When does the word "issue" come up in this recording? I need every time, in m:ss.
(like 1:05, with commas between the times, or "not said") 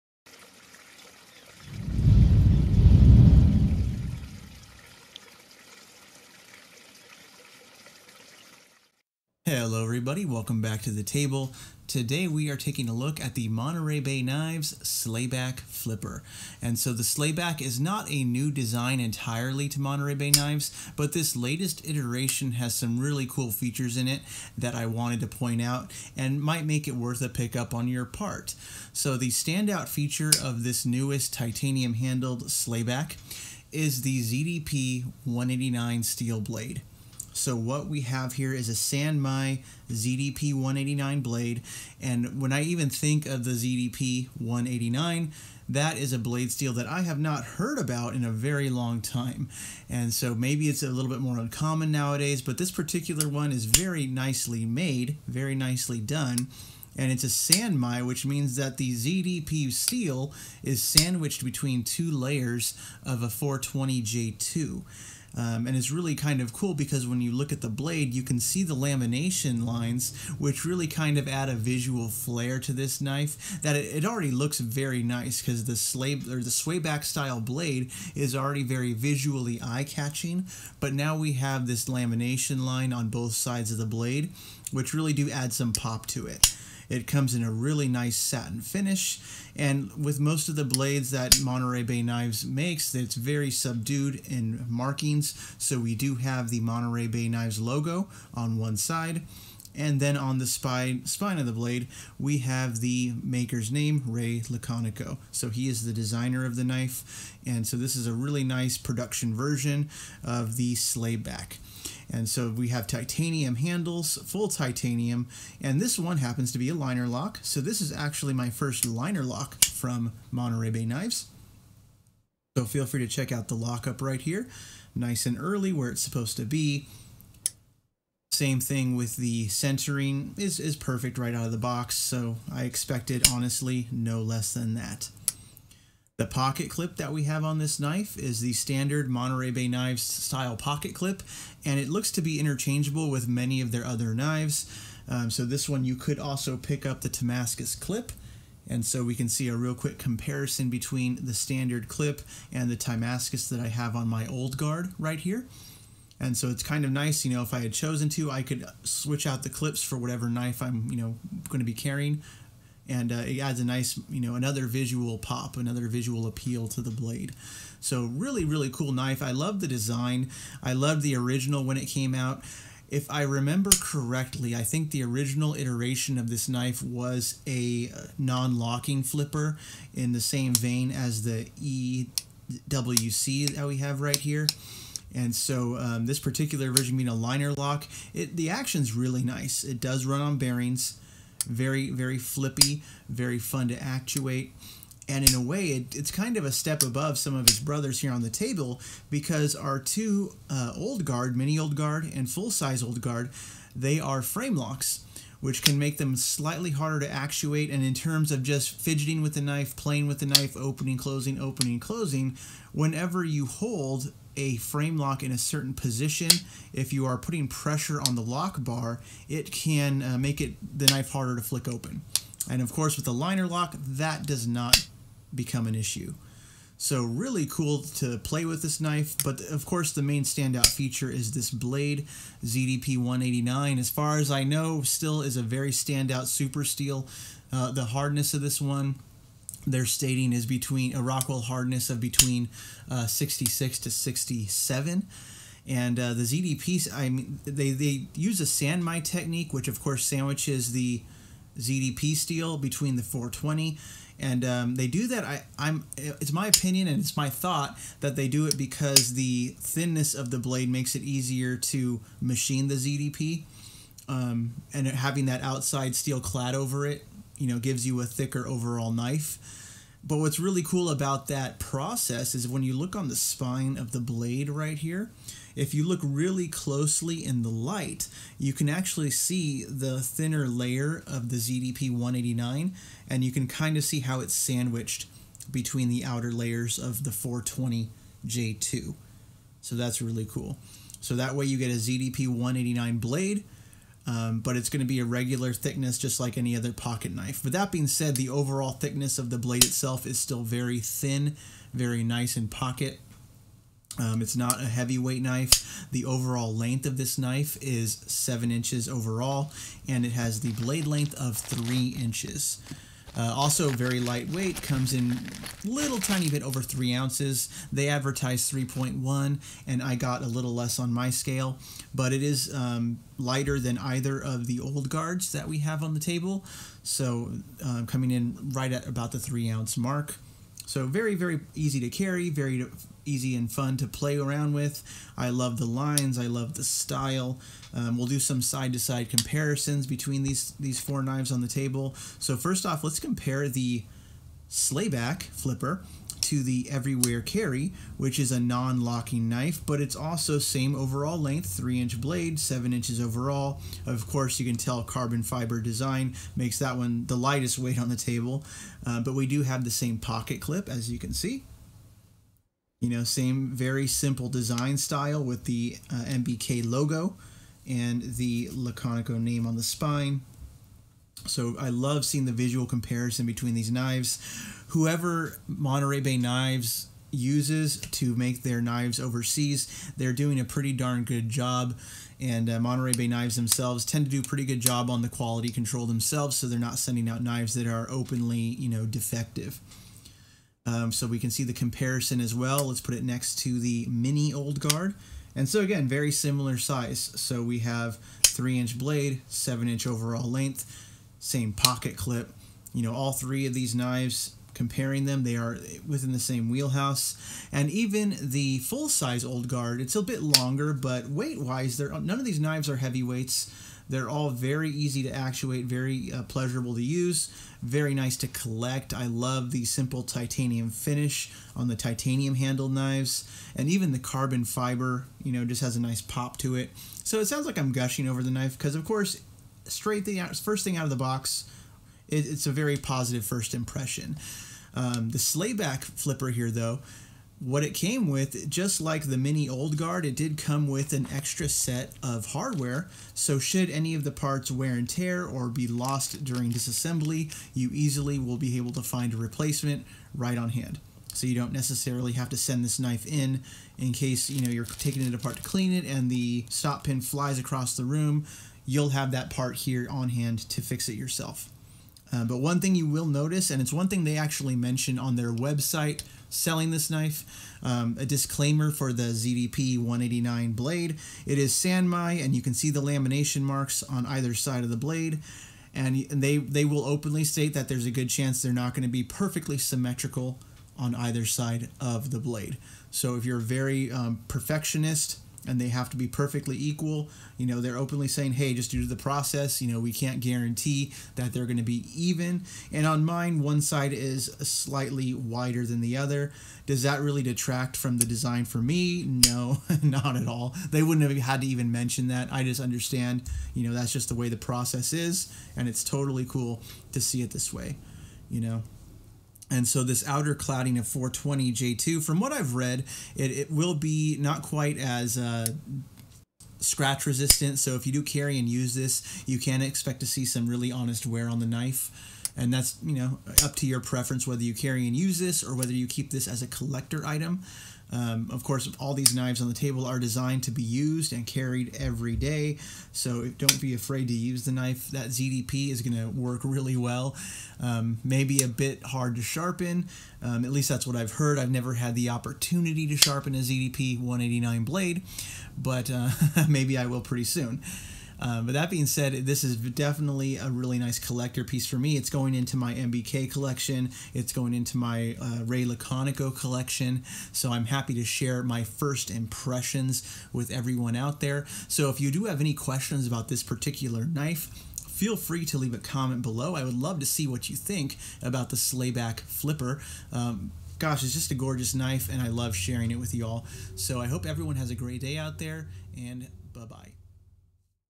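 3:45.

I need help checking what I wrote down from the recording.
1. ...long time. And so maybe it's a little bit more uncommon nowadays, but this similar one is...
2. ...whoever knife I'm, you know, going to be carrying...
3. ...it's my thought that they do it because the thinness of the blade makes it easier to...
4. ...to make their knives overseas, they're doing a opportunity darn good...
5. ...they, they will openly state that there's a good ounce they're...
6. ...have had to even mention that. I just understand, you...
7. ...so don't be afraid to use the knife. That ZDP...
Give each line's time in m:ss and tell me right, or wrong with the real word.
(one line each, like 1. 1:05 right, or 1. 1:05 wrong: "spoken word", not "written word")
1. 0:48 wrong: "particular", not "similar"
2. 2:39 wrong: "whatever", not "whoever"
3. 4:16 right
4. 6:17 wrong: "pretty", not "opportunity"
5. 7:56 wrong: "chance", not "ounce"
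6. 8:21 right
7. 8:52 right.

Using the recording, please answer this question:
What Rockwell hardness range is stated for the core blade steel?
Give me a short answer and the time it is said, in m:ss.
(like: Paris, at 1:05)
66 to 67, at 4:03.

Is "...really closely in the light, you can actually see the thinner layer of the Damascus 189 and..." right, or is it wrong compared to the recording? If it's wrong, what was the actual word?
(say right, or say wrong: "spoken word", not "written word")
wrong: "ZDP", not "Damascus".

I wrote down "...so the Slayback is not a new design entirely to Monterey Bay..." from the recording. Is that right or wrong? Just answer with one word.
right.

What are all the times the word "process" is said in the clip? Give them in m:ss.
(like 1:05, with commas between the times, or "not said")
4:31, 8:08, 8:24.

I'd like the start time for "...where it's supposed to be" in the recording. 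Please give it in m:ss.
2:05.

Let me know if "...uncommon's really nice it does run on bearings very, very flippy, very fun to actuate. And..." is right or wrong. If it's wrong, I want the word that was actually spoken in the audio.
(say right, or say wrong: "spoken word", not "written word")
wrong: "action", not "uncommon".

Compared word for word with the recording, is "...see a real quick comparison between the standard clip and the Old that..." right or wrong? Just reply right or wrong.
wrong.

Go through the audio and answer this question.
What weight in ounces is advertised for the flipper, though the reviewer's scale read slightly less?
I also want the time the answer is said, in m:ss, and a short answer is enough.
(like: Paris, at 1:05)
3.1, at 5:18.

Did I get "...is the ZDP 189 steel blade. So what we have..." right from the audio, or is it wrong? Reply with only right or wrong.
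right.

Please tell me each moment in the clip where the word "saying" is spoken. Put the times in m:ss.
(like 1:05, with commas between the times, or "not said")
8:08.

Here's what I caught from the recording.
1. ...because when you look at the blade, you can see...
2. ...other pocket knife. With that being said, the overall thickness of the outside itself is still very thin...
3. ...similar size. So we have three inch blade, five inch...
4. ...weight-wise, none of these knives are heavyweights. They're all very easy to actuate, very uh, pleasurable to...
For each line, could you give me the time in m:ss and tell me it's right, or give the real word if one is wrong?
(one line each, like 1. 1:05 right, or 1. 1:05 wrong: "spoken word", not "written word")
1. 1:06 right
2. 4:56 wrong: "blade", not "outside"
3. 6:36 wrong: "seven", not "five"
4. 6:51 right.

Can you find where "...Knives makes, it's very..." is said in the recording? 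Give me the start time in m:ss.
1:32.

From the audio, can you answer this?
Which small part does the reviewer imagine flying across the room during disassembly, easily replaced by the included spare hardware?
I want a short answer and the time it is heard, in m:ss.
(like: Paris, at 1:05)
Stop pin, at 7:36.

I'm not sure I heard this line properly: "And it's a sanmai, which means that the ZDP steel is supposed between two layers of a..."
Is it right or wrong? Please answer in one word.
wrong.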